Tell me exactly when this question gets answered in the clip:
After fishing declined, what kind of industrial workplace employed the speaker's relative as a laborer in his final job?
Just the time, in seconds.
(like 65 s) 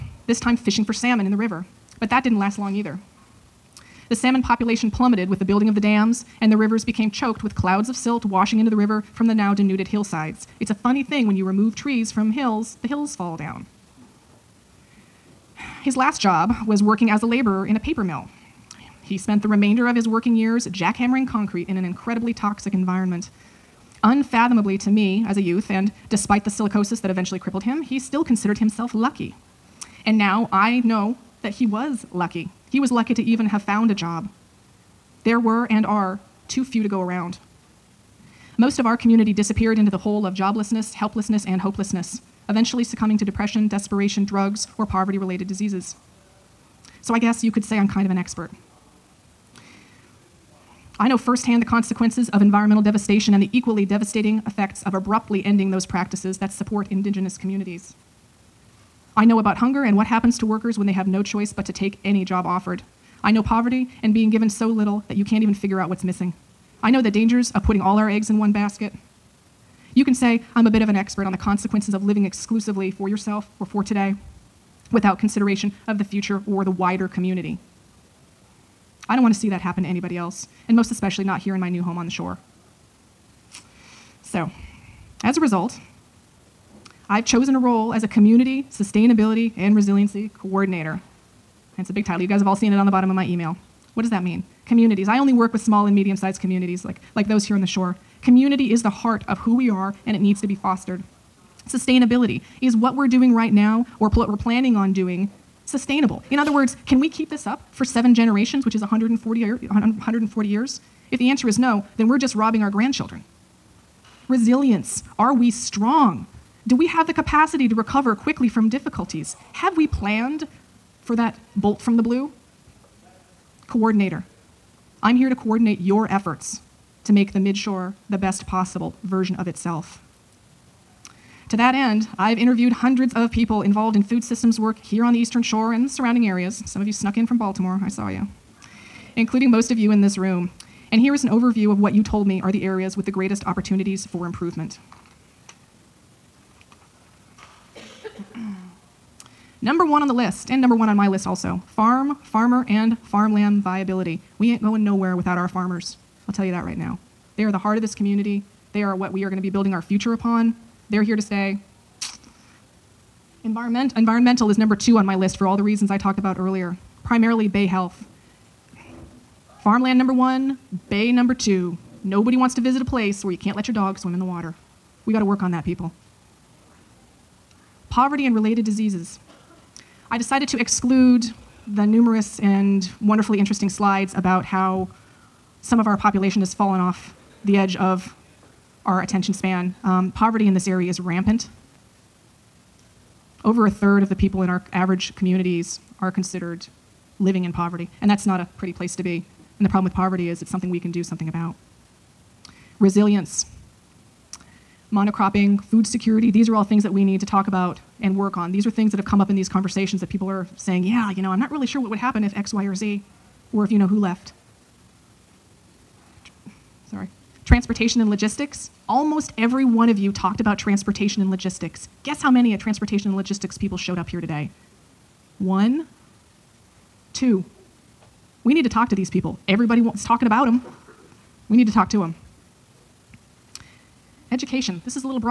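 17 s.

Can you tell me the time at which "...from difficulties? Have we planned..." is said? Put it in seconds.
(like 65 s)
118 s.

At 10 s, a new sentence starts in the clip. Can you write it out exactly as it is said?
It's a funny thing when you remove trees from hills, the hills fall down.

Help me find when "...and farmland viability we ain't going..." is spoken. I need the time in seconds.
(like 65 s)
152 s.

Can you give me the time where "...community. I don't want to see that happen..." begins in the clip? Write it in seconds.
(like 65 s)
77 s.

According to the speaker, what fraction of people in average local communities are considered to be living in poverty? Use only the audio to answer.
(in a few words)
over a third.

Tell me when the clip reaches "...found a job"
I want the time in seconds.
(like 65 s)
33 s.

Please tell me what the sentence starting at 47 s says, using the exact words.
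So I guess you could say I'm kind of an expert.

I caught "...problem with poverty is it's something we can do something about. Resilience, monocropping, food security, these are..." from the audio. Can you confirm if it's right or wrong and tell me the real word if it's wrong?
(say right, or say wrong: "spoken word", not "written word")
right.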